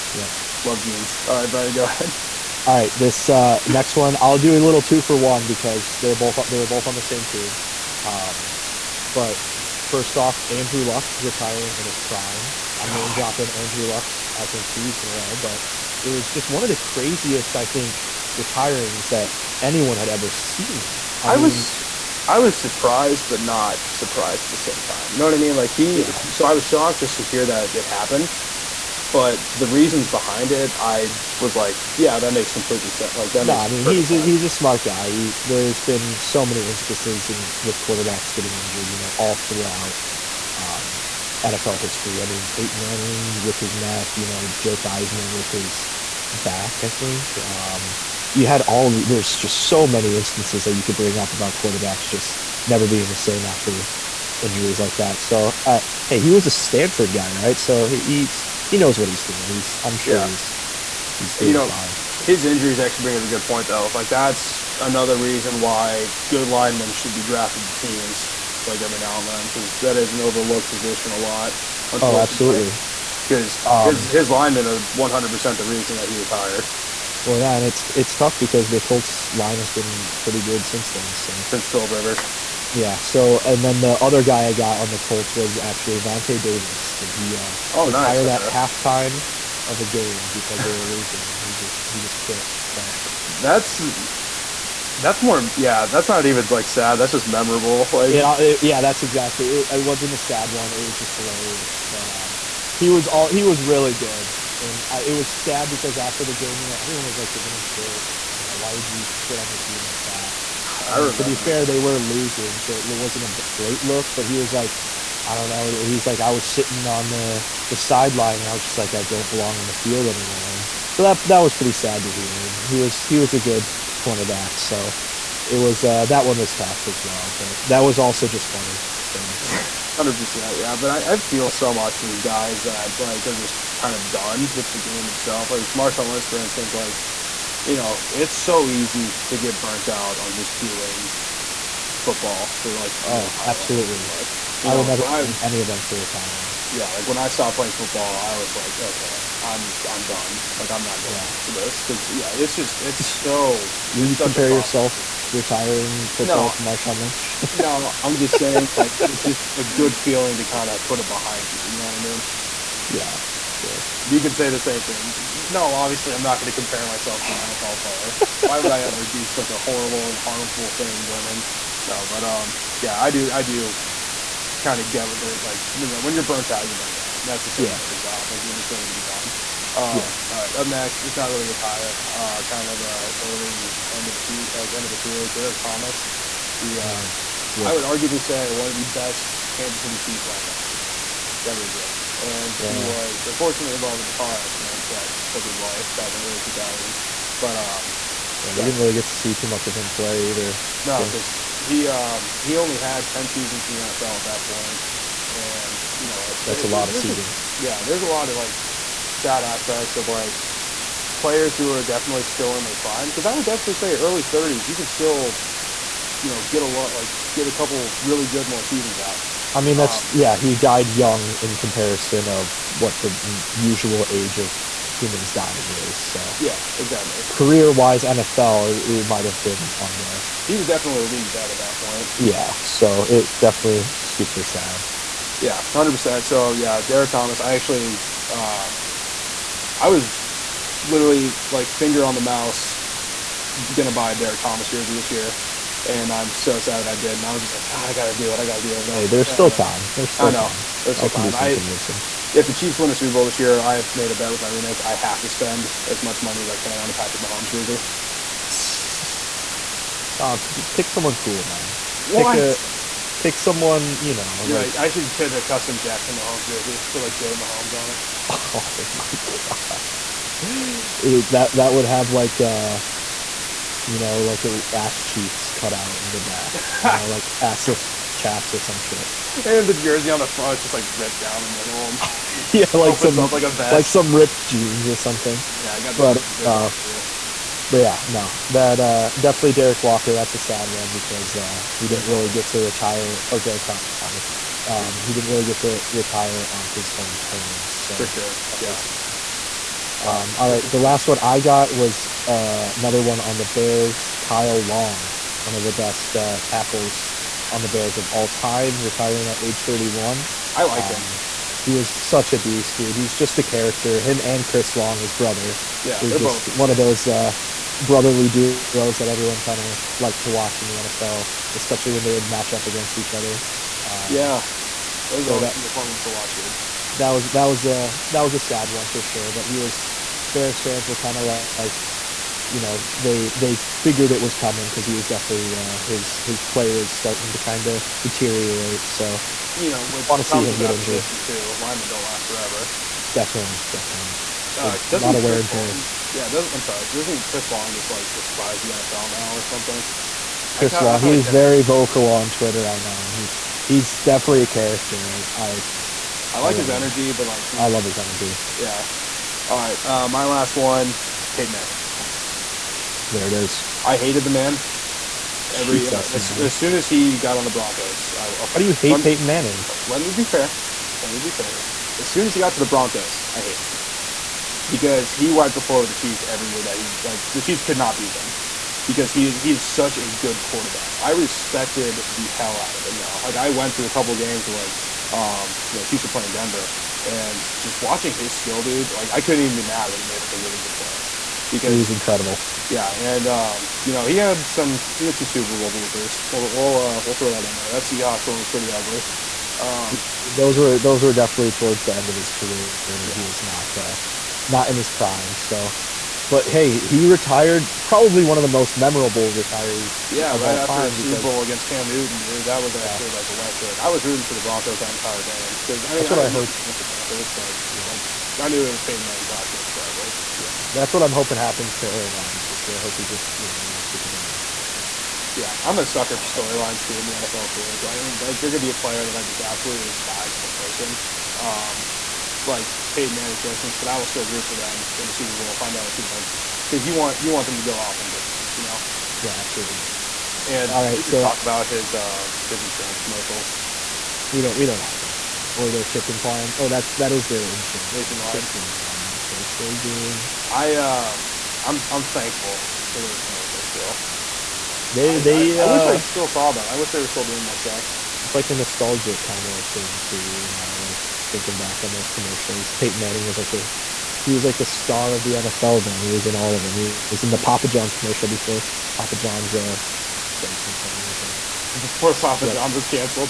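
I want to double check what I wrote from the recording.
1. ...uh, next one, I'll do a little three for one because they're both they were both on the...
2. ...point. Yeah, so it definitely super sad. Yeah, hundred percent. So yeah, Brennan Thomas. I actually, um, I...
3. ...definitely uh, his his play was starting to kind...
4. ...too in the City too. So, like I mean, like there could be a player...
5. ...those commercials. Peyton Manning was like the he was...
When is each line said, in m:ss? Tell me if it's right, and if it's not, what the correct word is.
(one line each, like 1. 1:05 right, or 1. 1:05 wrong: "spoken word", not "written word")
1. 0:03 wrong: "two", not "three"
2. 3:51 wrong: "Derrick", not "Brennan"
3. 5:35 right
4. 7:06 wrong: "NFL", not "City"
5. 7:41 right.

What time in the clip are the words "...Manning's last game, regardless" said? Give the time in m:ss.
6:59.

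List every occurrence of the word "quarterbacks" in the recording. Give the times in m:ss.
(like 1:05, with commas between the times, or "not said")
0:37, 0:51, 6:20.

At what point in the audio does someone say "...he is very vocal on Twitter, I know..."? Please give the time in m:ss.
5:51.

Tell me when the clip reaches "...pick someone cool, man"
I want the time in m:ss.
4:20.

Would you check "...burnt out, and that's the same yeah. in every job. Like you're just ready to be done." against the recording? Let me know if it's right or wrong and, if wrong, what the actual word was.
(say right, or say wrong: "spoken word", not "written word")
right.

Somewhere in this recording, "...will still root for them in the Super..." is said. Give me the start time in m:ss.
7:13.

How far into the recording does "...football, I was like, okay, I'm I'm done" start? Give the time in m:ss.
2:27.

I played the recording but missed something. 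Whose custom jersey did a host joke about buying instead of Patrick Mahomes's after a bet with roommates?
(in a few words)
Jackson Mahomes.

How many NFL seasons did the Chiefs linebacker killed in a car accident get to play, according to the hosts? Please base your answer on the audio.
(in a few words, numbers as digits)
10.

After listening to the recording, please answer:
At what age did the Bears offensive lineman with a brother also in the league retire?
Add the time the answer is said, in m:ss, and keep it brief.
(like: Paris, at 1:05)
31, at 5:09.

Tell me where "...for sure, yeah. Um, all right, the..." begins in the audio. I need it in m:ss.
4:57.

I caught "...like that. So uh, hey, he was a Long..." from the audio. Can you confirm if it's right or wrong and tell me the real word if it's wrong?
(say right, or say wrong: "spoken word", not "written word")
wrong: "Stanford", not "Long".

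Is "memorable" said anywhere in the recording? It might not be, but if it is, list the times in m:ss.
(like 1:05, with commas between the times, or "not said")
1:37, 6:48.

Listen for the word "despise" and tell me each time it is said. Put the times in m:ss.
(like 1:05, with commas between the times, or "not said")
5:48, 7:09.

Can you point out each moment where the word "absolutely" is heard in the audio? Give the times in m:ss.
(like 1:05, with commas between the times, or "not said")
1:12, 2:23, 7:09, 7:19.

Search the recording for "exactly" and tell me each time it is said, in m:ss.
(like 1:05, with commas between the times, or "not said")
1:39, 3:46.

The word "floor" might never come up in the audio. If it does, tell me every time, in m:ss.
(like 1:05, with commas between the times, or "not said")
6:15.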